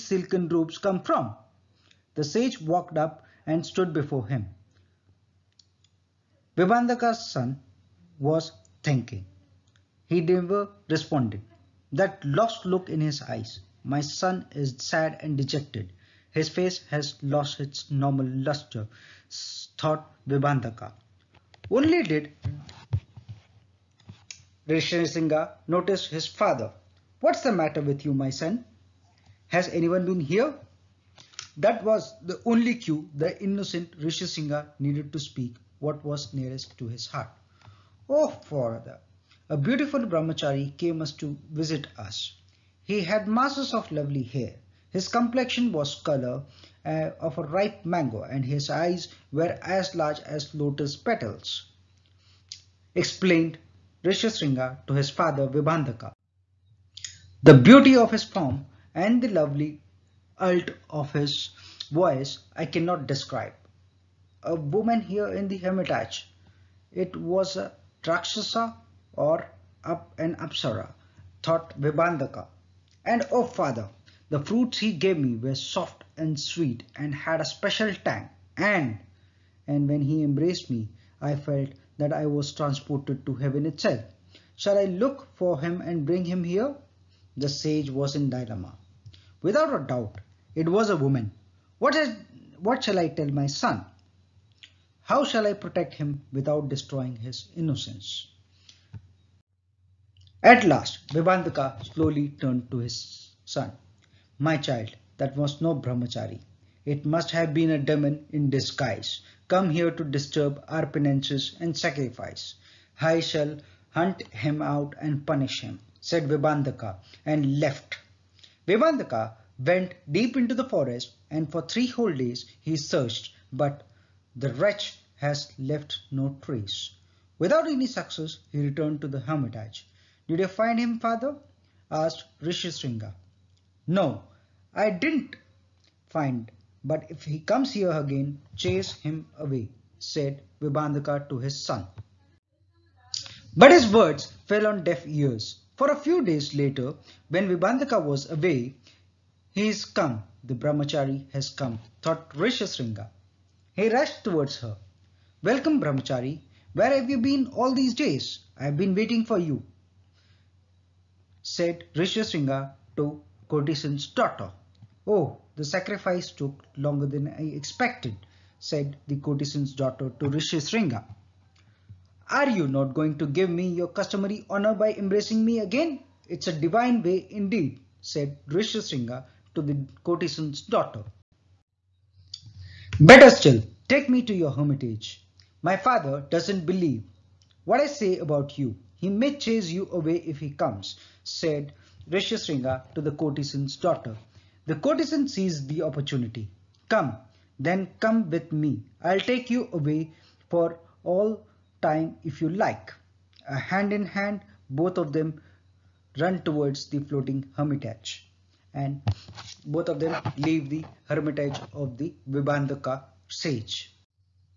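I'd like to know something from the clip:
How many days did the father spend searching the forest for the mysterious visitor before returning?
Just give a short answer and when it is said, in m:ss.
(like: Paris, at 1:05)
3, at 2:01.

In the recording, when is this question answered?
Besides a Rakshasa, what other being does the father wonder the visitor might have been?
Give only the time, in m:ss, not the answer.
1:10.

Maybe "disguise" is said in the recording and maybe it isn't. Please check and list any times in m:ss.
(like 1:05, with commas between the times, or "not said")
1:48.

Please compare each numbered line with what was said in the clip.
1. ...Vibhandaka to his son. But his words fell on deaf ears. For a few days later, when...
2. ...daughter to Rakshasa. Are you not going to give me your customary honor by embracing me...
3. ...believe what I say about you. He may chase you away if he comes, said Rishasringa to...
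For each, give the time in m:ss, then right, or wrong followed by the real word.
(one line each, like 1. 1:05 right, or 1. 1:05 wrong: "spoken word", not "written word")
1. 2:20 right
2. 2:49 wrong: "Rishasringa", not "Rakshasa"
3. 3:06 right.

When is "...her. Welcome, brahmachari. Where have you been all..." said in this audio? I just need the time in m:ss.
2:34.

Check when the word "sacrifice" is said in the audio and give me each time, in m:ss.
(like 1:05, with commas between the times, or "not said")
1:51, 2:45.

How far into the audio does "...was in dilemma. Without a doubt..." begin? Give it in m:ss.
1:27.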